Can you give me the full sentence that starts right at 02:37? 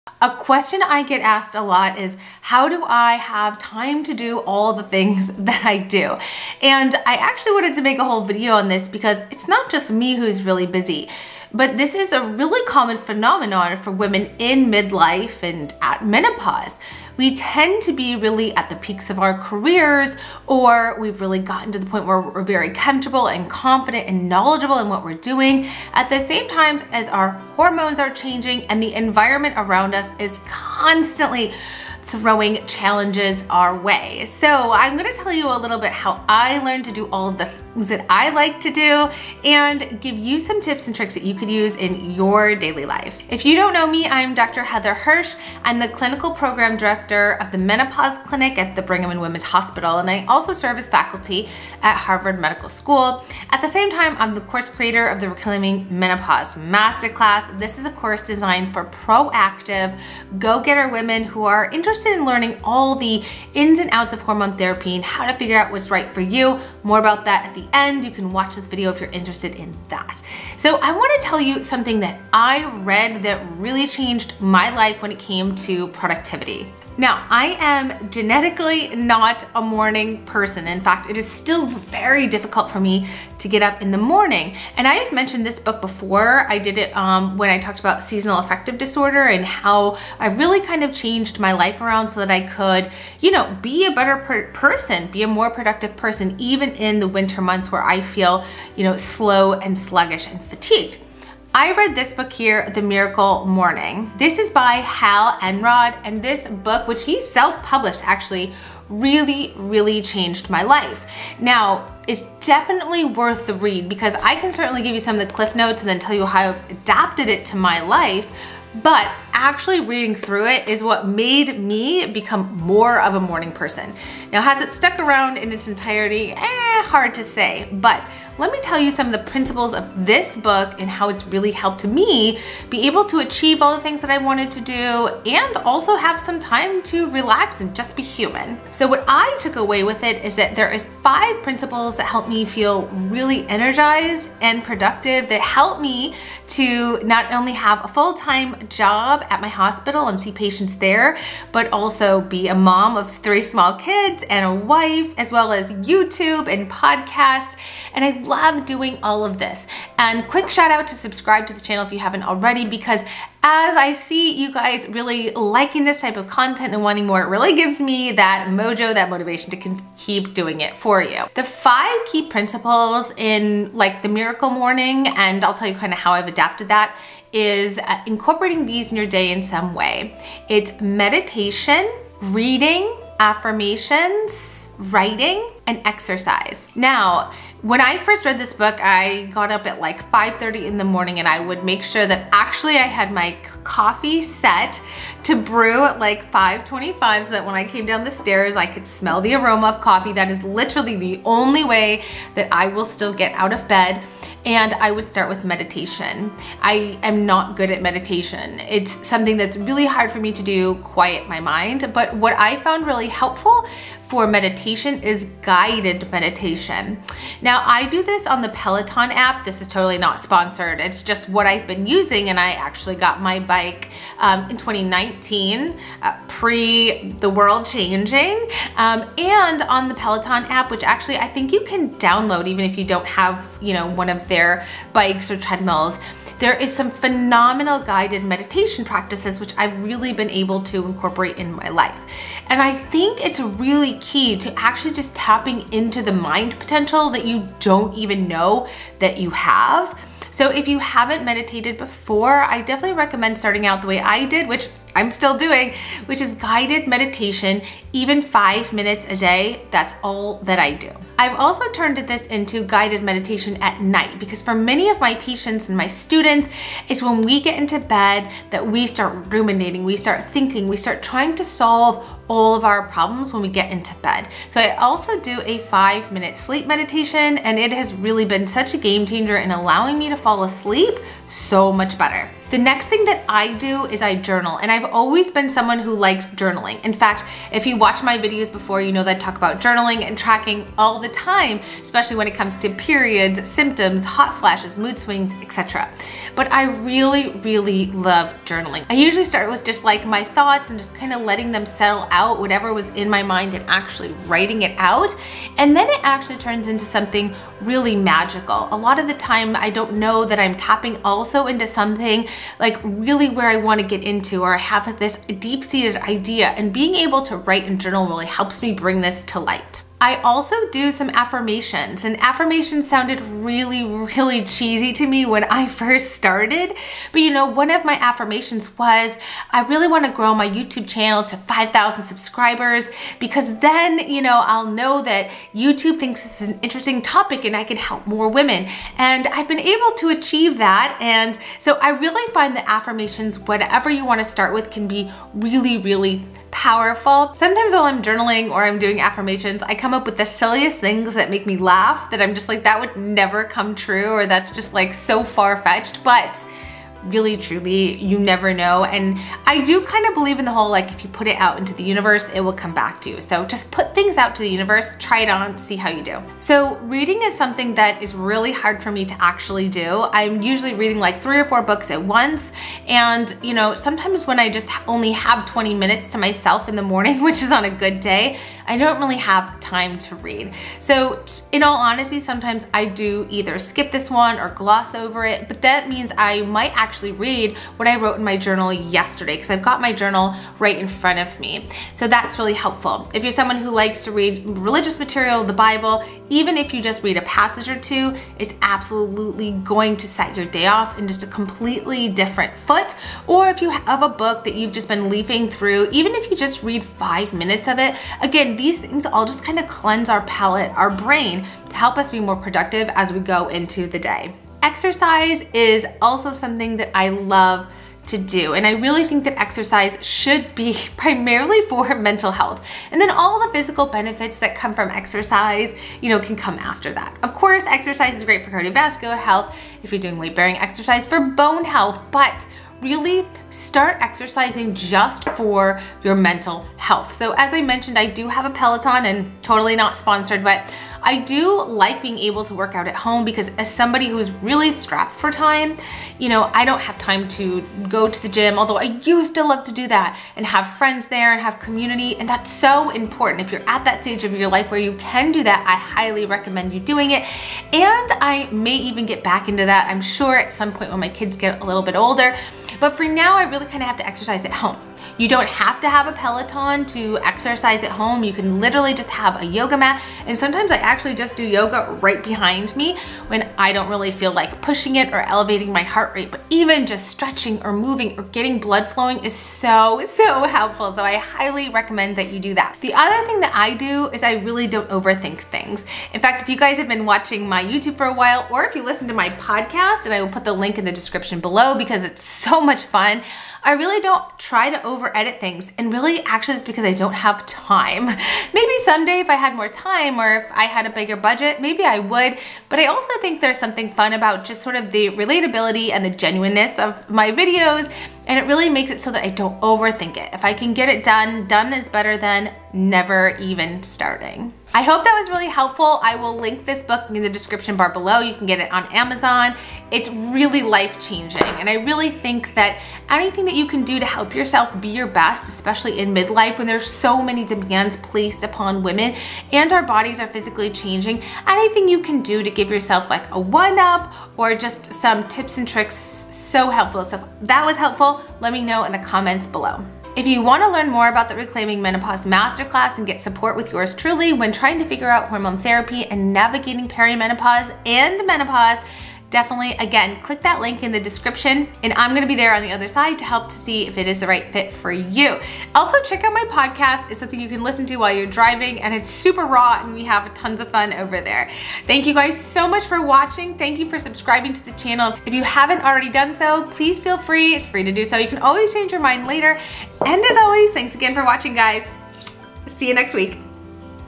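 And I love doing all of this.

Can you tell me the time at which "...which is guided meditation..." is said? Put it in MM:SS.
04:16.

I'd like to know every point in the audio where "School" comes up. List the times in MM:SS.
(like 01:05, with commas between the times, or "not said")
00:52.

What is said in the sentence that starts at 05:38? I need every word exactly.
And I've been able to achieve that.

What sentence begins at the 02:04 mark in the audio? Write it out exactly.
Now, has it stuck around in its entirety?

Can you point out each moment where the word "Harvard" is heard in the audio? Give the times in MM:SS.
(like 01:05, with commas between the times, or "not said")
00:51.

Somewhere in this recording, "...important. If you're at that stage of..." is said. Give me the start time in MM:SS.
07:32.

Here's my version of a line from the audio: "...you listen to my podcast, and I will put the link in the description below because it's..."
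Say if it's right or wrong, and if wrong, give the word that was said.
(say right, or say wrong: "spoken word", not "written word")
right.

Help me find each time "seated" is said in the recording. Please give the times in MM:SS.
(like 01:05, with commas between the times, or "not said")
05:15.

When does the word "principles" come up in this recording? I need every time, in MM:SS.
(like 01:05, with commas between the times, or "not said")
02:09, 02:21, 02:52.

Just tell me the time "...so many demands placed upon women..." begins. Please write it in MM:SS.
08:46.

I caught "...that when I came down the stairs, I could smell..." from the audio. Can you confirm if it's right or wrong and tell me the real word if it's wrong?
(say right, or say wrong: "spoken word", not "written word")
right.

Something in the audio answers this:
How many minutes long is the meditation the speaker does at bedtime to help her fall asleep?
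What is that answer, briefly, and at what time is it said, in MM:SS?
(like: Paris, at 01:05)
5, at 04:35.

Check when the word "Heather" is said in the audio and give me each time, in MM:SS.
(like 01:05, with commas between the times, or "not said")
00:44.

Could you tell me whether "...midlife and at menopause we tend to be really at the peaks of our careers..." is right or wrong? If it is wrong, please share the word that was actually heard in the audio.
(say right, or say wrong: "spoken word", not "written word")
right.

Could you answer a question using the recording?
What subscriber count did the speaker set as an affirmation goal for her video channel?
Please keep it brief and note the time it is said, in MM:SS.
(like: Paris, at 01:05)
5,000, at 05:31.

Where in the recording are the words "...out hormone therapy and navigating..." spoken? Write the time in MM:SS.
09:05.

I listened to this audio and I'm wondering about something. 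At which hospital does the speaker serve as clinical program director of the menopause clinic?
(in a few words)
Brigham and Women's Hospital.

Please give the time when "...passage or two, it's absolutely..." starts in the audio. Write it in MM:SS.
06:37.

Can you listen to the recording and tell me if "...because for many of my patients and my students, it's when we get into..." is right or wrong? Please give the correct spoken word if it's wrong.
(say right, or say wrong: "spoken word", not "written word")
right.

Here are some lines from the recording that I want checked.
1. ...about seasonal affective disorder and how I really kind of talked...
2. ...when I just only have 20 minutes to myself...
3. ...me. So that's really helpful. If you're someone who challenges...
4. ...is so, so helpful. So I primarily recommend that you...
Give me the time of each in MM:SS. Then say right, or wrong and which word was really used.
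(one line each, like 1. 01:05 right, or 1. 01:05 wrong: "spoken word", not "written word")
1. 01:27 wrong: "changed", not "talked"
2. 06:14 right
3. 06:31 wrong: "likes", not "challenges"
4. 07:59 wrong: "highly", not "primarily".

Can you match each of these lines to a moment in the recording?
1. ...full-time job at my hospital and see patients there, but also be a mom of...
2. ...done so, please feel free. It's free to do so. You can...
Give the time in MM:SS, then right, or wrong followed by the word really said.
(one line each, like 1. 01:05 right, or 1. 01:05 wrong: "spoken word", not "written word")
1. 02:27 right
2. 09:26 right.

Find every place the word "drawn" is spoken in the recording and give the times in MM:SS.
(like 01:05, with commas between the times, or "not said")
not said.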